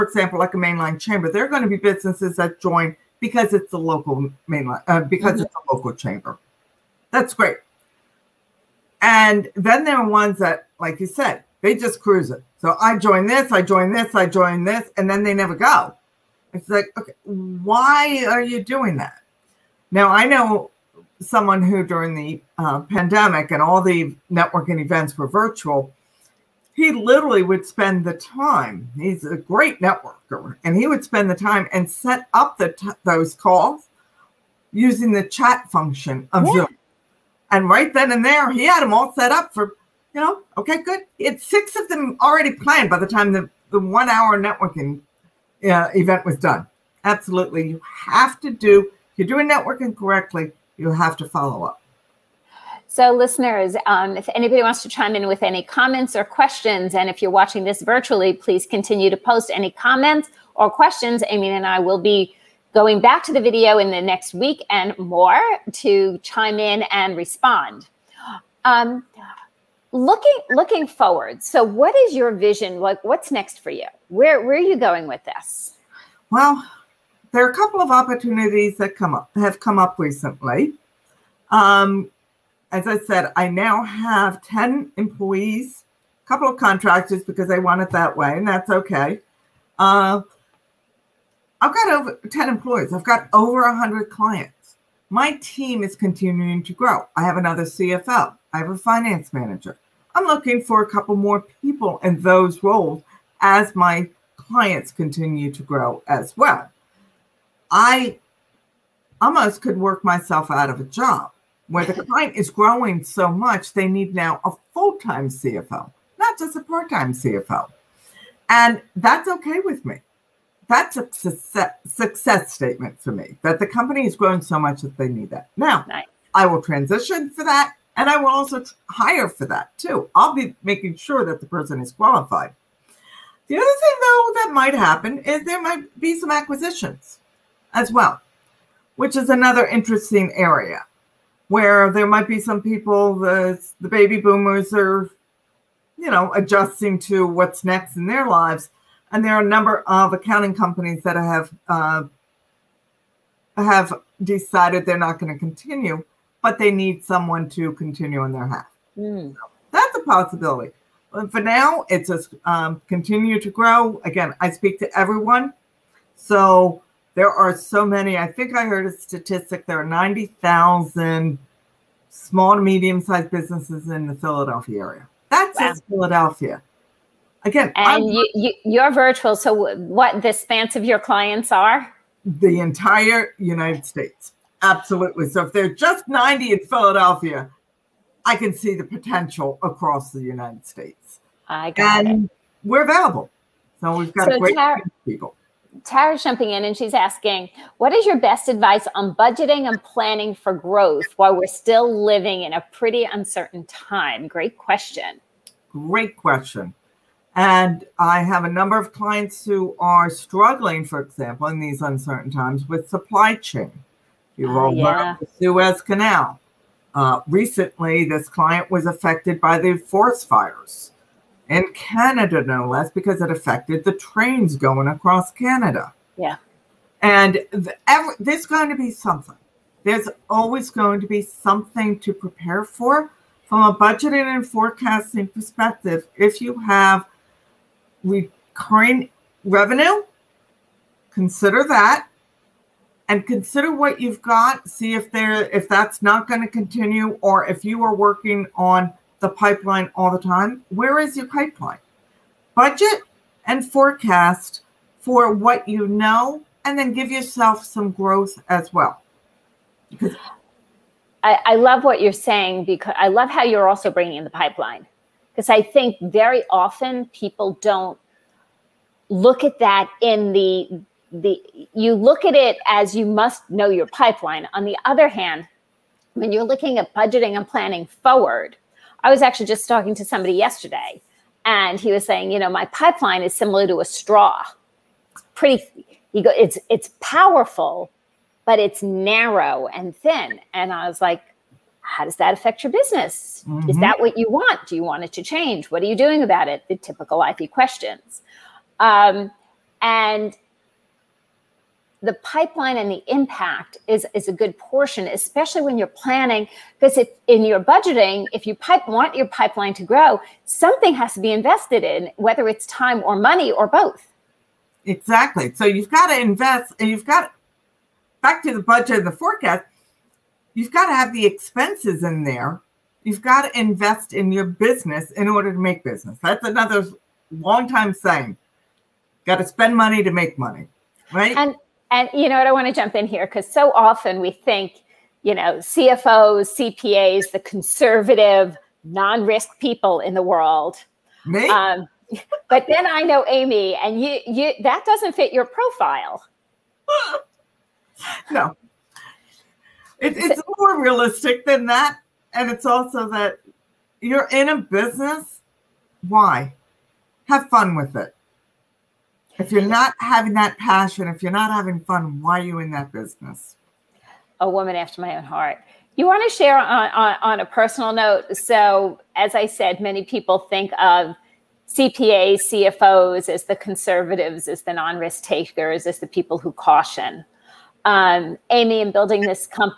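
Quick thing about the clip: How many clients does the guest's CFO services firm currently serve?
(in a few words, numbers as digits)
over 100.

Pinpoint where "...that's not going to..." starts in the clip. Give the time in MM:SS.
04:05.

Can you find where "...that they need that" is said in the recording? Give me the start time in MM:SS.
02:04.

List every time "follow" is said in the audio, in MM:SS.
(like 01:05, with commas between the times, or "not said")
00:51.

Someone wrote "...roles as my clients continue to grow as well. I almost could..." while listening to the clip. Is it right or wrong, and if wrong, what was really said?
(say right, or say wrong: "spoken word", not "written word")
right.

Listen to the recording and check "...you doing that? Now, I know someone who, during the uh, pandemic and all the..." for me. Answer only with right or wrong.
right.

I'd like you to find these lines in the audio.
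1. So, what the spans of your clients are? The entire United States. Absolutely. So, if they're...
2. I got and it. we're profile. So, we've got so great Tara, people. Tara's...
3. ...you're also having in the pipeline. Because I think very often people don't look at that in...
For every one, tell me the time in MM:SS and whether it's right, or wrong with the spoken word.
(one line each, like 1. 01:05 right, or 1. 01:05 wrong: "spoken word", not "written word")
1. 02:59 right
2. 03:11 wrong: "available", not "profile"
3. 04:23 wrong: "bringing", not "having".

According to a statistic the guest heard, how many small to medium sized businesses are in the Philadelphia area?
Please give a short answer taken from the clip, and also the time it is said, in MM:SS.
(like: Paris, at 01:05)
90,000, at 02:49.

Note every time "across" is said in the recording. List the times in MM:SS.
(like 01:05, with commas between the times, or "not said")
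03:09, 03:44.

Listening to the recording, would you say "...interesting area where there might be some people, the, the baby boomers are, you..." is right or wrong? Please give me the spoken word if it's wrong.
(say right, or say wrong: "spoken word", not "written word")
right.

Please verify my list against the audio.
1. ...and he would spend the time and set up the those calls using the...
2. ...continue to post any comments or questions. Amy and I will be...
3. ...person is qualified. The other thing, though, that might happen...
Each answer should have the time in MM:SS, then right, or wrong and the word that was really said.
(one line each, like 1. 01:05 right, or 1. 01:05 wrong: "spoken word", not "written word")
1. 00:30 right
2. 00:58 right
3. 02:11 right.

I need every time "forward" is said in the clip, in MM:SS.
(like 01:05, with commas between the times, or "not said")
01:10, 04:37.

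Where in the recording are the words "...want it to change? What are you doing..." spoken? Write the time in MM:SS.
04:54.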